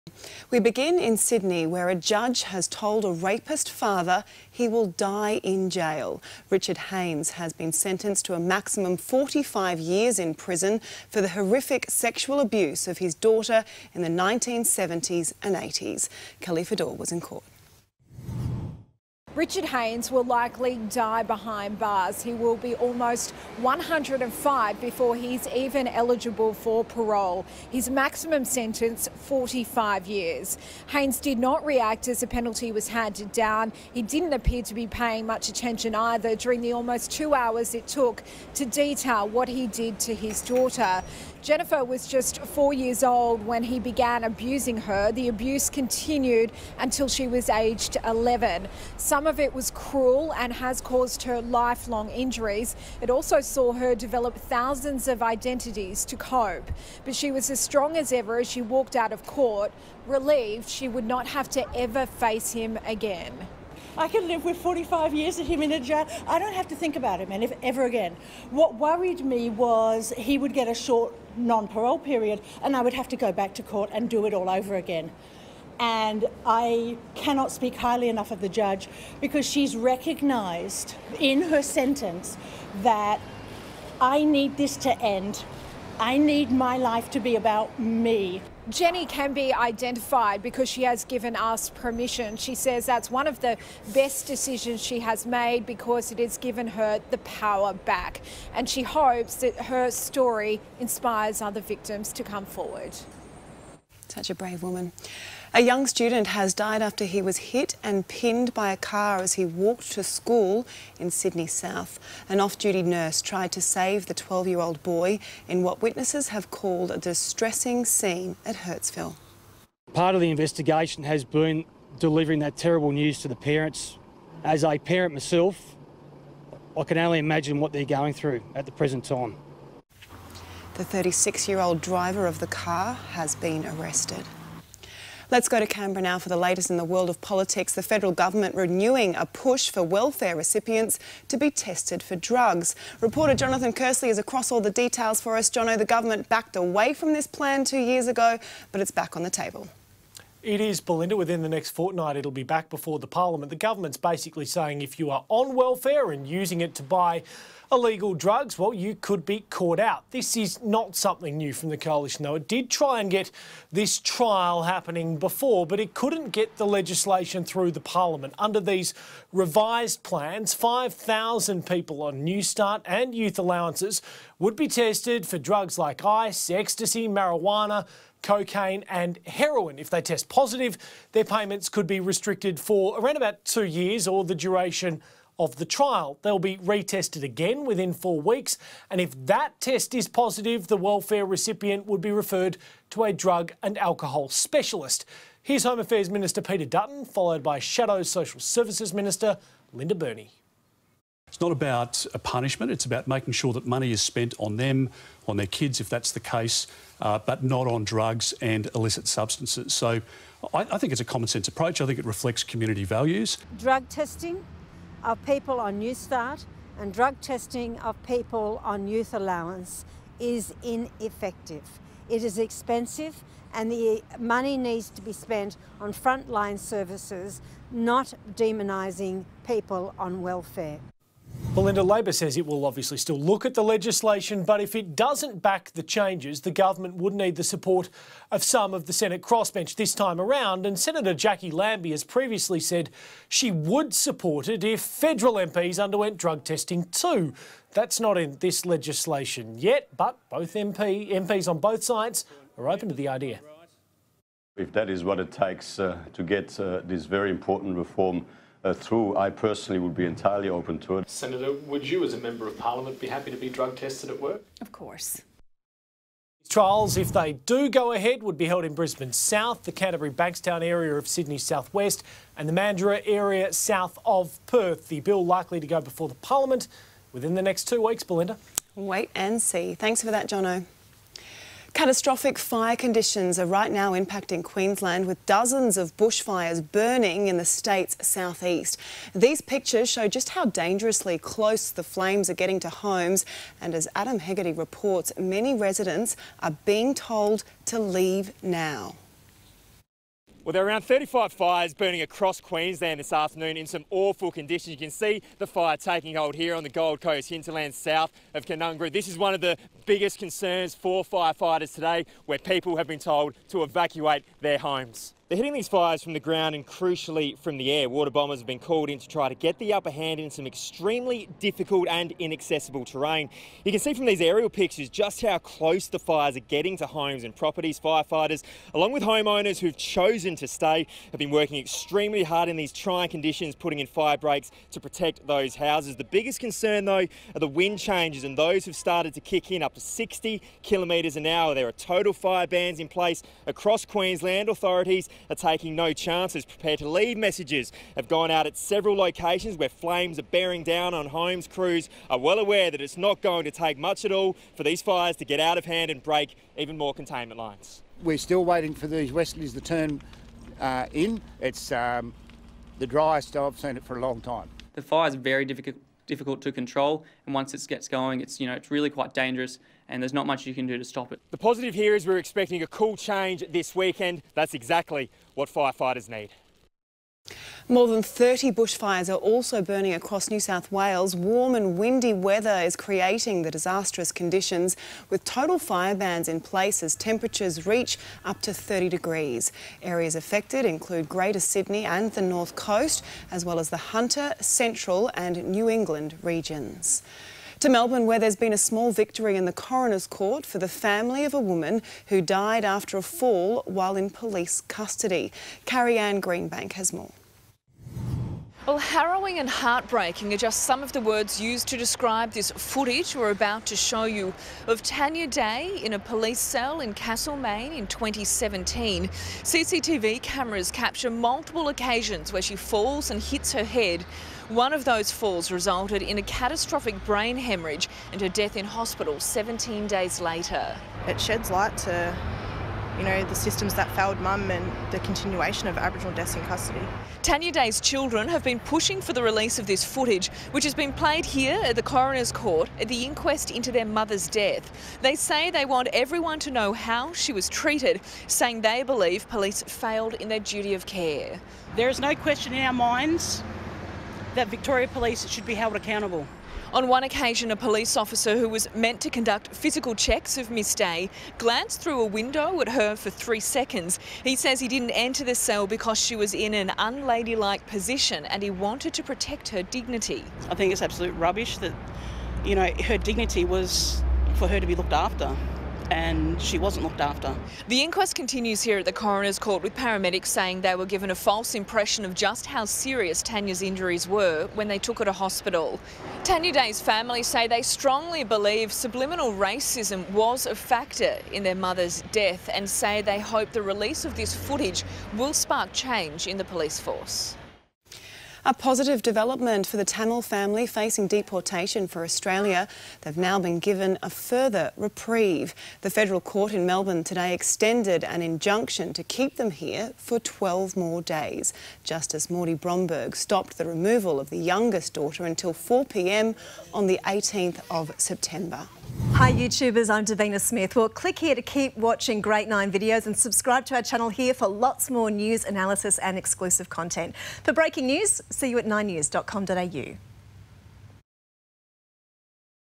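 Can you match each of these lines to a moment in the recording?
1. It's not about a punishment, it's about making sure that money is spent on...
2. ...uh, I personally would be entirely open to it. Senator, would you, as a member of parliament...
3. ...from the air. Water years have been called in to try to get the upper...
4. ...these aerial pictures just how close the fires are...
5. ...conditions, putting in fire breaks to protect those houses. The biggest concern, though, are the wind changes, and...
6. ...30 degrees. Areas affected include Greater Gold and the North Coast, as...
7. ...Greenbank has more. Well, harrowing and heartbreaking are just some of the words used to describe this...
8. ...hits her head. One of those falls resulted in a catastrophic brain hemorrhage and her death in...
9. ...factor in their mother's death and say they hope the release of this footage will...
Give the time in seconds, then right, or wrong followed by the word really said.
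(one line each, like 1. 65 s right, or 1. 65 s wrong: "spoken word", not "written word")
1. 201 s right
2. 258 s right
3. 317 s wrong: "bombers", not "years"
4. 324 s right
5. 333 s right
6. 388 s wrong: "Sydney", not "Gold"
7. 406 s right
8. 423 s right
9. 490 s right.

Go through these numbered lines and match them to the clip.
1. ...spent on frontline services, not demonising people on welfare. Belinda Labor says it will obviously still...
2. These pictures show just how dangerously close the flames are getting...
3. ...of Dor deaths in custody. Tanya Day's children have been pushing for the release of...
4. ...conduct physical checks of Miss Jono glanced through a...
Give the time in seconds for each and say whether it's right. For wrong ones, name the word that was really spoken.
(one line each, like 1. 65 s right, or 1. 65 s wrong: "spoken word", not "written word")
1. 225 s right
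2. 289 s right
3. 435 s wrong: "Aboriginal", not "Dor"
4. 459 s wrong: "Day", not "Jono".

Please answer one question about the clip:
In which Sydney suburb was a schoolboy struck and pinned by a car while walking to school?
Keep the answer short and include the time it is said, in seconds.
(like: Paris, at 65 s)
Hurstville, at 118 s.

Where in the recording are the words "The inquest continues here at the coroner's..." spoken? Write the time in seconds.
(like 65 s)
477 s.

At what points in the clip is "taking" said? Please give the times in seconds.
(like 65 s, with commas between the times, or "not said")
305 s, 345 s.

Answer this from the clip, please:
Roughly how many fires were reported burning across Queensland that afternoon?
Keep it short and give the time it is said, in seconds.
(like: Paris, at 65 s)
35, at 300 s.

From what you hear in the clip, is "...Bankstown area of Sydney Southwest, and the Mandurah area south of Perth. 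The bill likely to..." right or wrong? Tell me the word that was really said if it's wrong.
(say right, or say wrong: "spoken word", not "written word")
right.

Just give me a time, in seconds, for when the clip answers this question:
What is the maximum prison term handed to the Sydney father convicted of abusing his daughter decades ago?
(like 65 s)
8 s.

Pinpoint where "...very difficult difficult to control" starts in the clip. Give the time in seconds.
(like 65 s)
365 s.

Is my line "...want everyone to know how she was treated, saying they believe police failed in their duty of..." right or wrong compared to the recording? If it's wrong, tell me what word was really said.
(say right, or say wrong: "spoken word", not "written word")
right.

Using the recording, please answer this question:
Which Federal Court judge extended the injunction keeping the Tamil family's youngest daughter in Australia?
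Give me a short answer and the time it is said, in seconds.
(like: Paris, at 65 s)
Mordy Bromberg, at 512 s.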